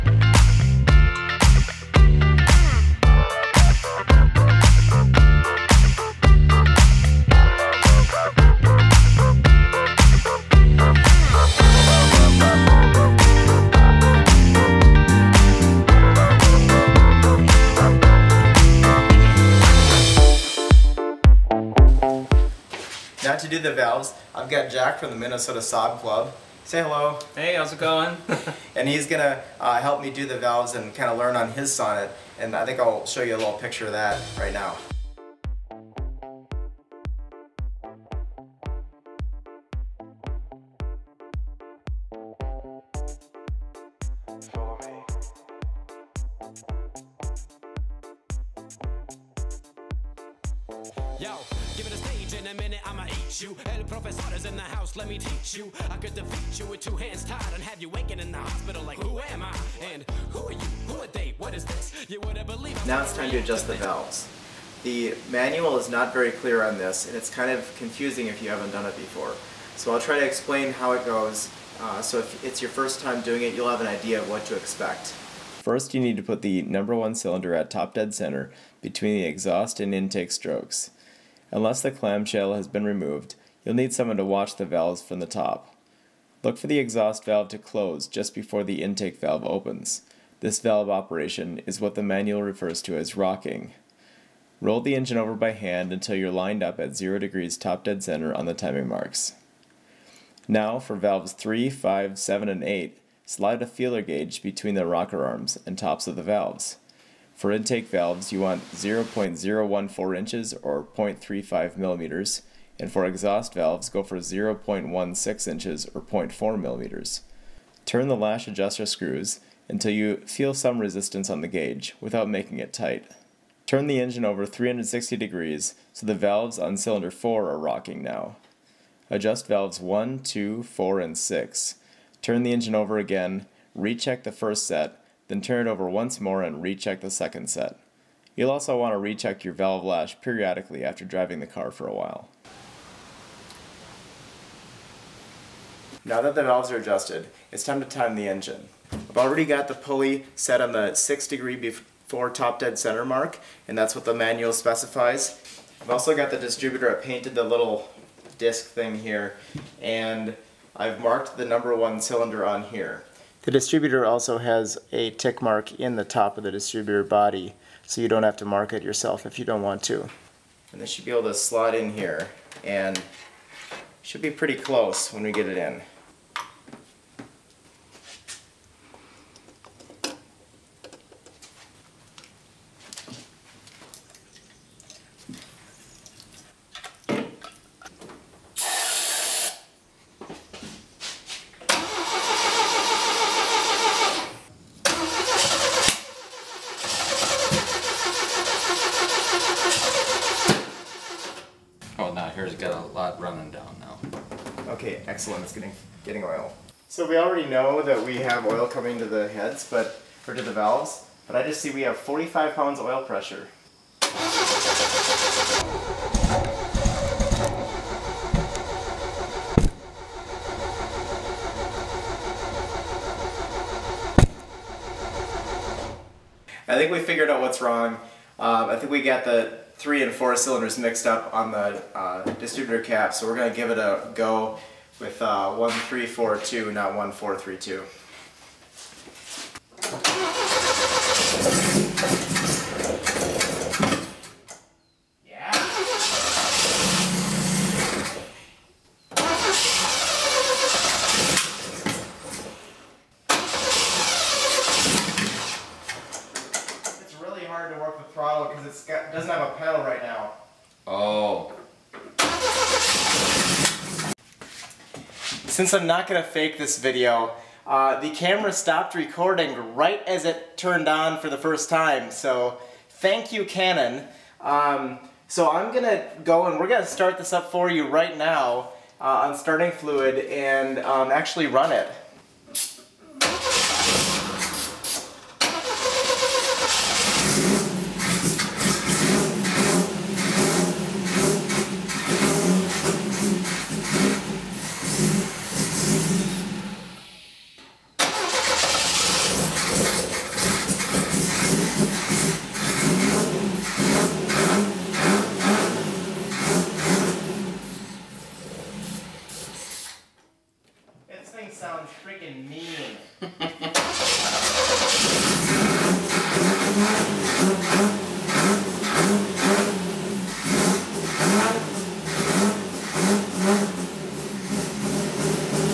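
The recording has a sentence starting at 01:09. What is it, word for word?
So I'll try to explain how it goes.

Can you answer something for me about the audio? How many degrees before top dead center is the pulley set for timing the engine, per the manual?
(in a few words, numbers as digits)
6 degrees.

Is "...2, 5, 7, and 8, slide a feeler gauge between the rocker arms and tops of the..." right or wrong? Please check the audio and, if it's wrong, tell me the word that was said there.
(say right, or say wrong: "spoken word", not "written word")
wrong: "3", not "2".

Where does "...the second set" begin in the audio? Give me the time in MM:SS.
02:16.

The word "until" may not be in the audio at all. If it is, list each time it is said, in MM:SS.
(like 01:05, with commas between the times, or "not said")
01:35, 01:59.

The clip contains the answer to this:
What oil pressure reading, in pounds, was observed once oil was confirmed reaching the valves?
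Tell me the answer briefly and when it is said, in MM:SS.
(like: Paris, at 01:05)
45 pounds, at 03:31.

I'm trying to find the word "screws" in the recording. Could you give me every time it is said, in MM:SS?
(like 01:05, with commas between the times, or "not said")
01:58.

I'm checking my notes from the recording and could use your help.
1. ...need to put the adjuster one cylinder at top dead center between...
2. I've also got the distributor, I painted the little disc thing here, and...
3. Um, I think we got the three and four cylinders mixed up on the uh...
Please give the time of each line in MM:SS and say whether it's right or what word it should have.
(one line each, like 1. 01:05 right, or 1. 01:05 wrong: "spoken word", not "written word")
1. 01:15 wrong: "number", not "adjuster"
2. 02:35 right
3. 03:48 right.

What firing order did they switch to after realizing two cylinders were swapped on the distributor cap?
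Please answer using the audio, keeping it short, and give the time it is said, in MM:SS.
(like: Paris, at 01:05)
1342, at 03:55.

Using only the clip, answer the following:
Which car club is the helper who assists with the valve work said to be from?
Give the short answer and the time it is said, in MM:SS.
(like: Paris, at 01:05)
Minnesota Saab Club, at 00:25.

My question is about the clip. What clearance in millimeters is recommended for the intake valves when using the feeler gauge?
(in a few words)
0.35 millimeters.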